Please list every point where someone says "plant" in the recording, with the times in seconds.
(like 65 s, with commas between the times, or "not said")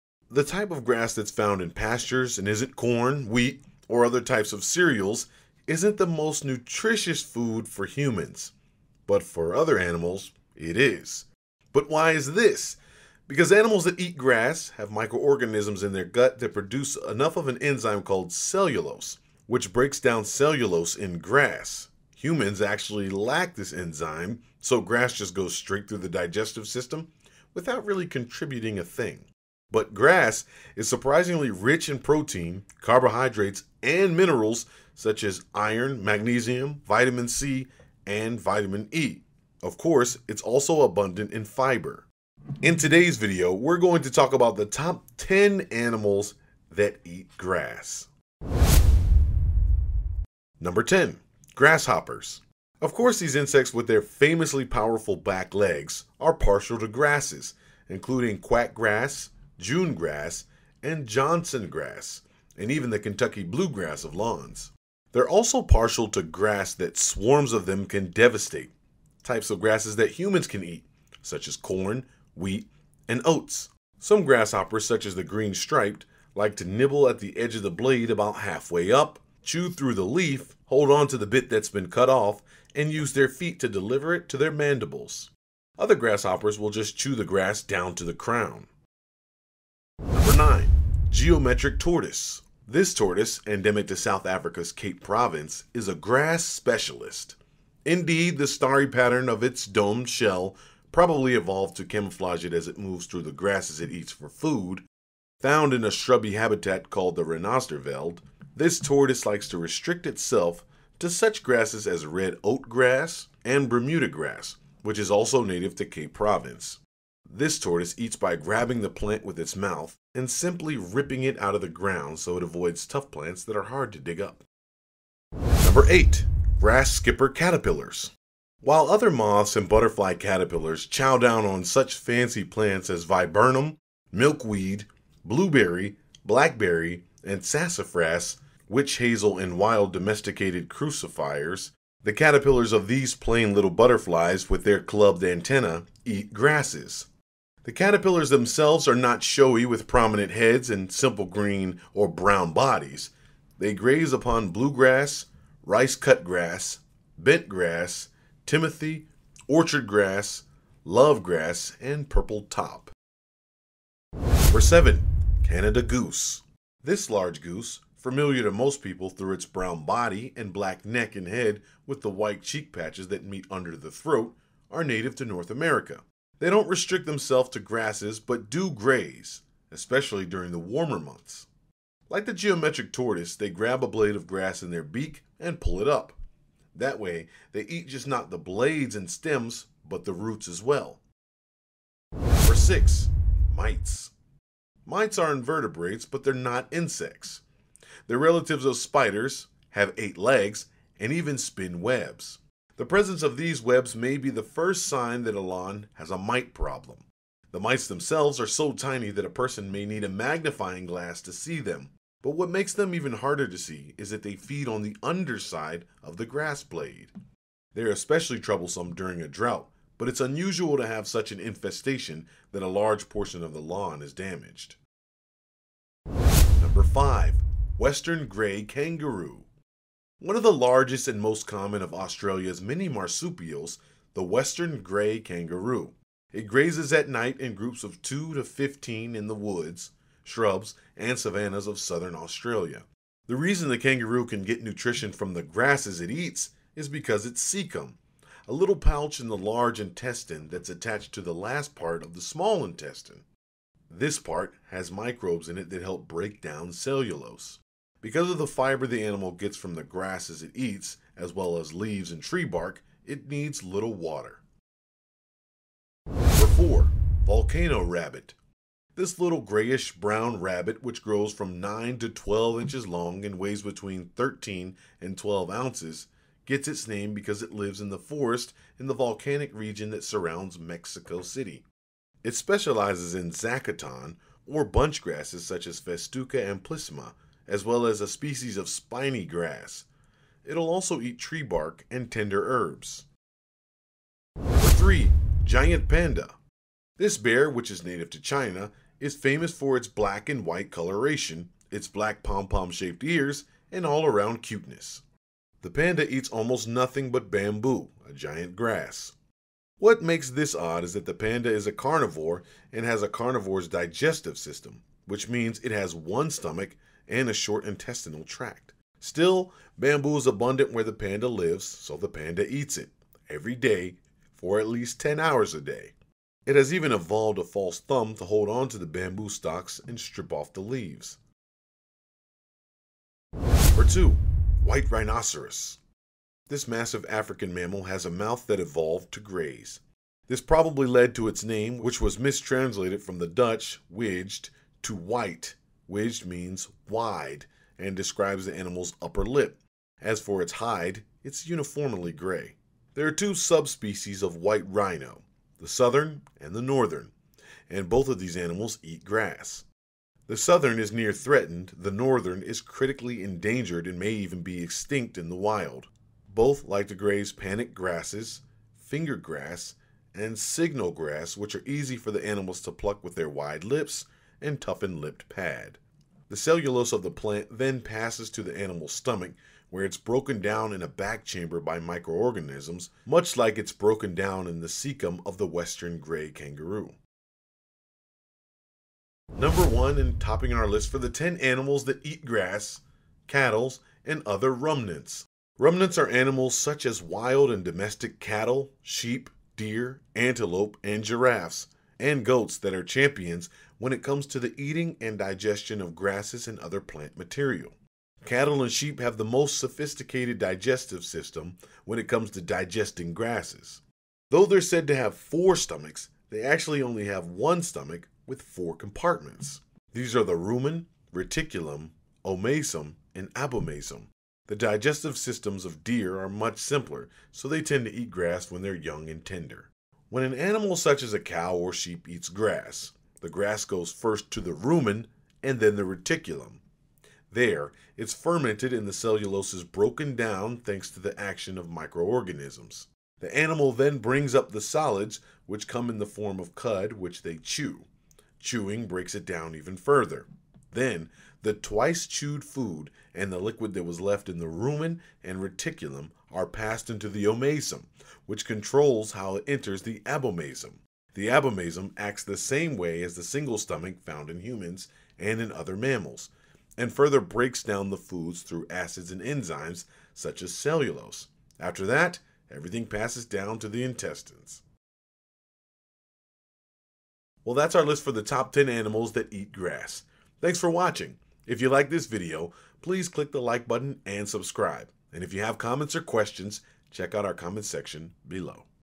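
118 s, 123 s, 132 s, 377 s, 406 s.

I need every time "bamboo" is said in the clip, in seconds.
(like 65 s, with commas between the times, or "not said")
307 s, 319 s, 328 s.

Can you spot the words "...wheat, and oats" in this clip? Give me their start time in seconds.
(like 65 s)
72 s.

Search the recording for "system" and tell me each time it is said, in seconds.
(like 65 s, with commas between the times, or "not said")
26 s, 314 s, 411 s, 425 s.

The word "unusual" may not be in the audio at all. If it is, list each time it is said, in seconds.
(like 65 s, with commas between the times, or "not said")
220 s.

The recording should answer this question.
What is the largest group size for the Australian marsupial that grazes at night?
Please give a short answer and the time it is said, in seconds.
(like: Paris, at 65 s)
15, at 238 s.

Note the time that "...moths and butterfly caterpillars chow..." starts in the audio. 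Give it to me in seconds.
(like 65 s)
129 s.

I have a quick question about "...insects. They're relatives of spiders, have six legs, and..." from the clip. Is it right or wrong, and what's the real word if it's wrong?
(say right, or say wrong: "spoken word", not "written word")
wrong: "eight", not "six".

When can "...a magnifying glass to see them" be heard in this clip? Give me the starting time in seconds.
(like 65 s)
210 s.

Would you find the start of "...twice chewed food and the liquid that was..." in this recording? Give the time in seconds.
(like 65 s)
451 s.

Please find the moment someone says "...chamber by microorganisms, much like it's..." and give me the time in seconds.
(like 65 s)
381 s.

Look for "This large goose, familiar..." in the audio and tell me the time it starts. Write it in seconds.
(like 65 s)
166 s.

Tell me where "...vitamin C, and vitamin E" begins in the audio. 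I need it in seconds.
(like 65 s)
36 s.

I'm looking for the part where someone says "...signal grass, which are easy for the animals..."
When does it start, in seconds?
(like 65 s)
370 s.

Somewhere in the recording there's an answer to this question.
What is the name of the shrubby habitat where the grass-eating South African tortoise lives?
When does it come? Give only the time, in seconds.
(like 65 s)
107 s.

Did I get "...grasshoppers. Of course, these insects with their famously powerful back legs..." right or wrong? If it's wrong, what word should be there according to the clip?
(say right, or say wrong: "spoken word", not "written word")
right.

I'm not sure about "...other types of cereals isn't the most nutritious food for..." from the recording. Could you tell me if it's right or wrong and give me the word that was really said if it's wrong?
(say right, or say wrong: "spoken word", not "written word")
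right.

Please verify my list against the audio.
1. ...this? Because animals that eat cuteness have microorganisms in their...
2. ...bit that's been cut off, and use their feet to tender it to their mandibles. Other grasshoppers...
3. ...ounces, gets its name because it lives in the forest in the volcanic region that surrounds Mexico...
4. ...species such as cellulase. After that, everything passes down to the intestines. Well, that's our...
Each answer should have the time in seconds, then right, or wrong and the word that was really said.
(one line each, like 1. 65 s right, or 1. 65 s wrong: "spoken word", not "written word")
1. 12 s wrong: "grass", not "cuteness"
2. 81 s wrong: "deliver", not "tender"
3. 275 s right
4. 469 s wrong: "enzymes", not "species".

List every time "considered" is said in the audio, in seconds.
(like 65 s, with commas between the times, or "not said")
not said.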